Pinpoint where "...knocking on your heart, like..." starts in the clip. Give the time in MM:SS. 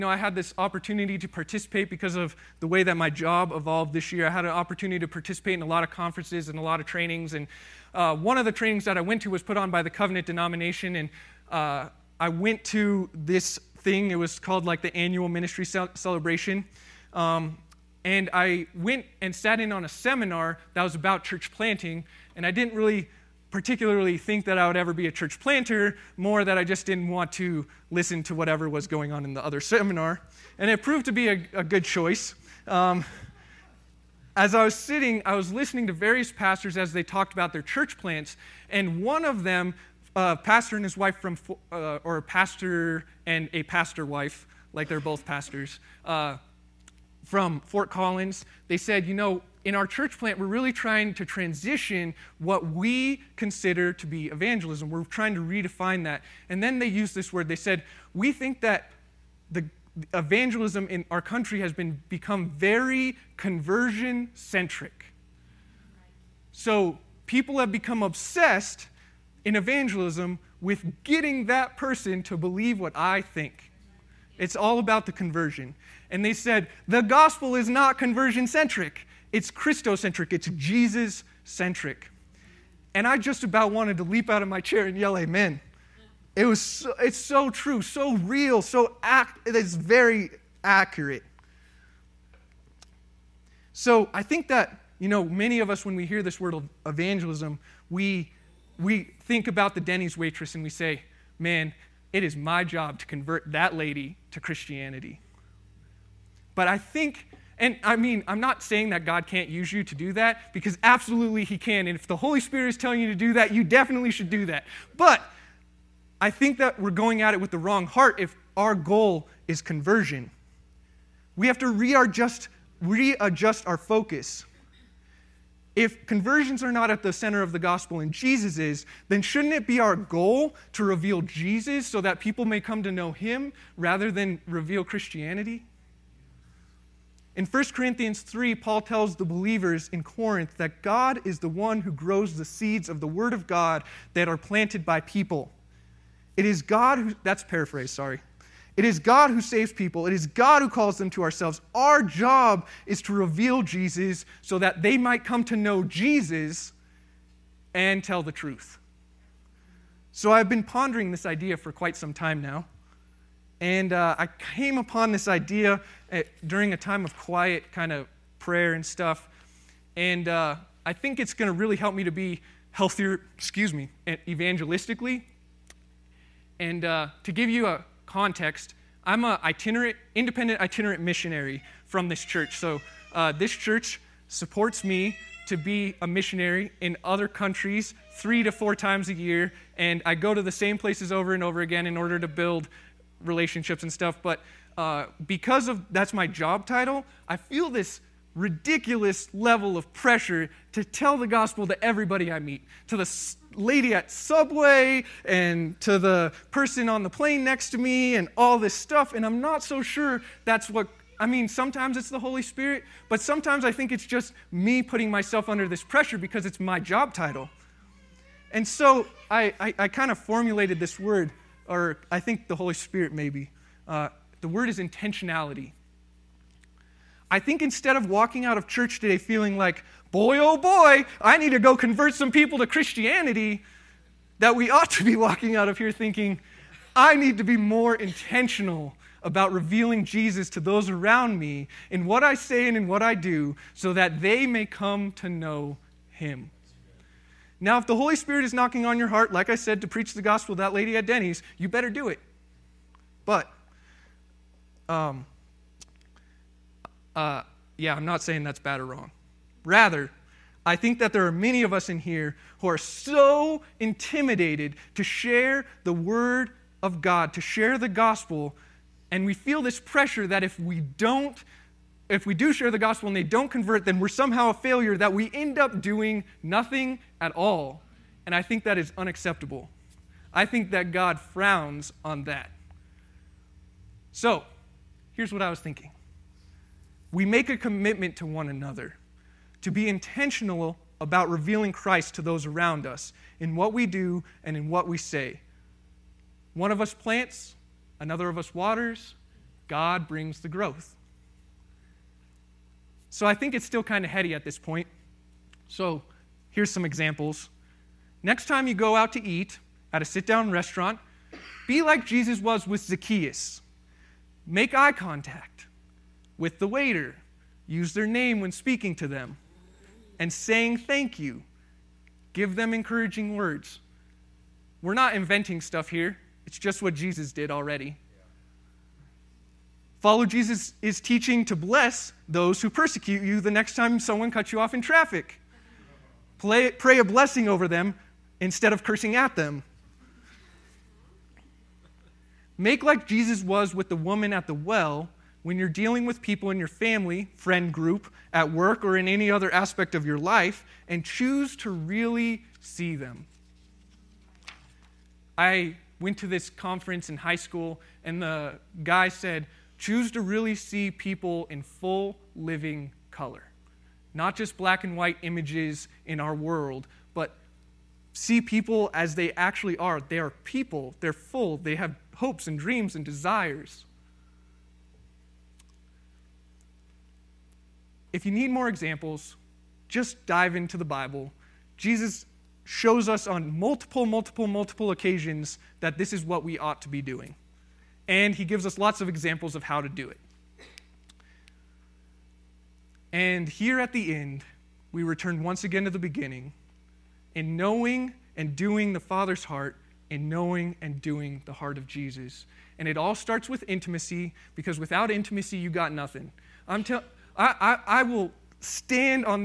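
04:08.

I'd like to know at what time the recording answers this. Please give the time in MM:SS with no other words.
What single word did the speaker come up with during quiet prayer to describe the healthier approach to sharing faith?
03:44.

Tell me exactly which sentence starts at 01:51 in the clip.
And if the Holy Spirit is telling you to do that, you definitely should do that.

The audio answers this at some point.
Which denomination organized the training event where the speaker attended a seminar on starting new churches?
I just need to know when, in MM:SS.
00:09.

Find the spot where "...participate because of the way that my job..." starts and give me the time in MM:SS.
00:01.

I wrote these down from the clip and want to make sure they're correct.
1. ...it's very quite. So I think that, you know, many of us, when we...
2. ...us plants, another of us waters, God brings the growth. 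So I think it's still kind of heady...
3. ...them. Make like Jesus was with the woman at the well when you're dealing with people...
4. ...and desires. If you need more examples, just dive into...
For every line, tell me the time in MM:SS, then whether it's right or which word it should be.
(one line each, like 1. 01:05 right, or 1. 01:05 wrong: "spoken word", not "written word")
1. 01:29 wrong: "accurate", not "quite"
2. 04:56 right
3. 05:39 right
4. 06:12 right.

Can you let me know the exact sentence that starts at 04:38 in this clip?
And I think that is unacceptable.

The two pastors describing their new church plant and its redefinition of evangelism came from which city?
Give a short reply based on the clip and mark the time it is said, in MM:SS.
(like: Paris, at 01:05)
Fort Collins, at 00:47.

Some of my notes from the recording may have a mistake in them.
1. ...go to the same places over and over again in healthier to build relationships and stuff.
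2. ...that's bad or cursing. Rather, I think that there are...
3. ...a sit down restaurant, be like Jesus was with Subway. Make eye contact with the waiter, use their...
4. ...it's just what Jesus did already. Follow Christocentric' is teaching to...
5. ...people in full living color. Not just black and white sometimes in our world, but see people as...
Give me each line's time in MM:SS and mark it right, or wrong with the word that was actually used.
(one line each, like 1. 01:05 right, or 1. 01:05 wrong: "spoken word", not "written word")
1. 03:10 wrong: "order", not "healthier"
2. 04:18 wrong: "wrong", not "cursing"
3. 05:10 wrong: "Zacchaeus", not "Subway"
4. 05:26 wrong: "Jesus", not "Christocentric"
5. 06:00 wrong: "images", not "sometimes".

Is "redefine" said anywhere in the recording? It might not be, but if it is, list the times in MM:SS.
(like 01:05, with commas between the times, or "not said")
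00:55.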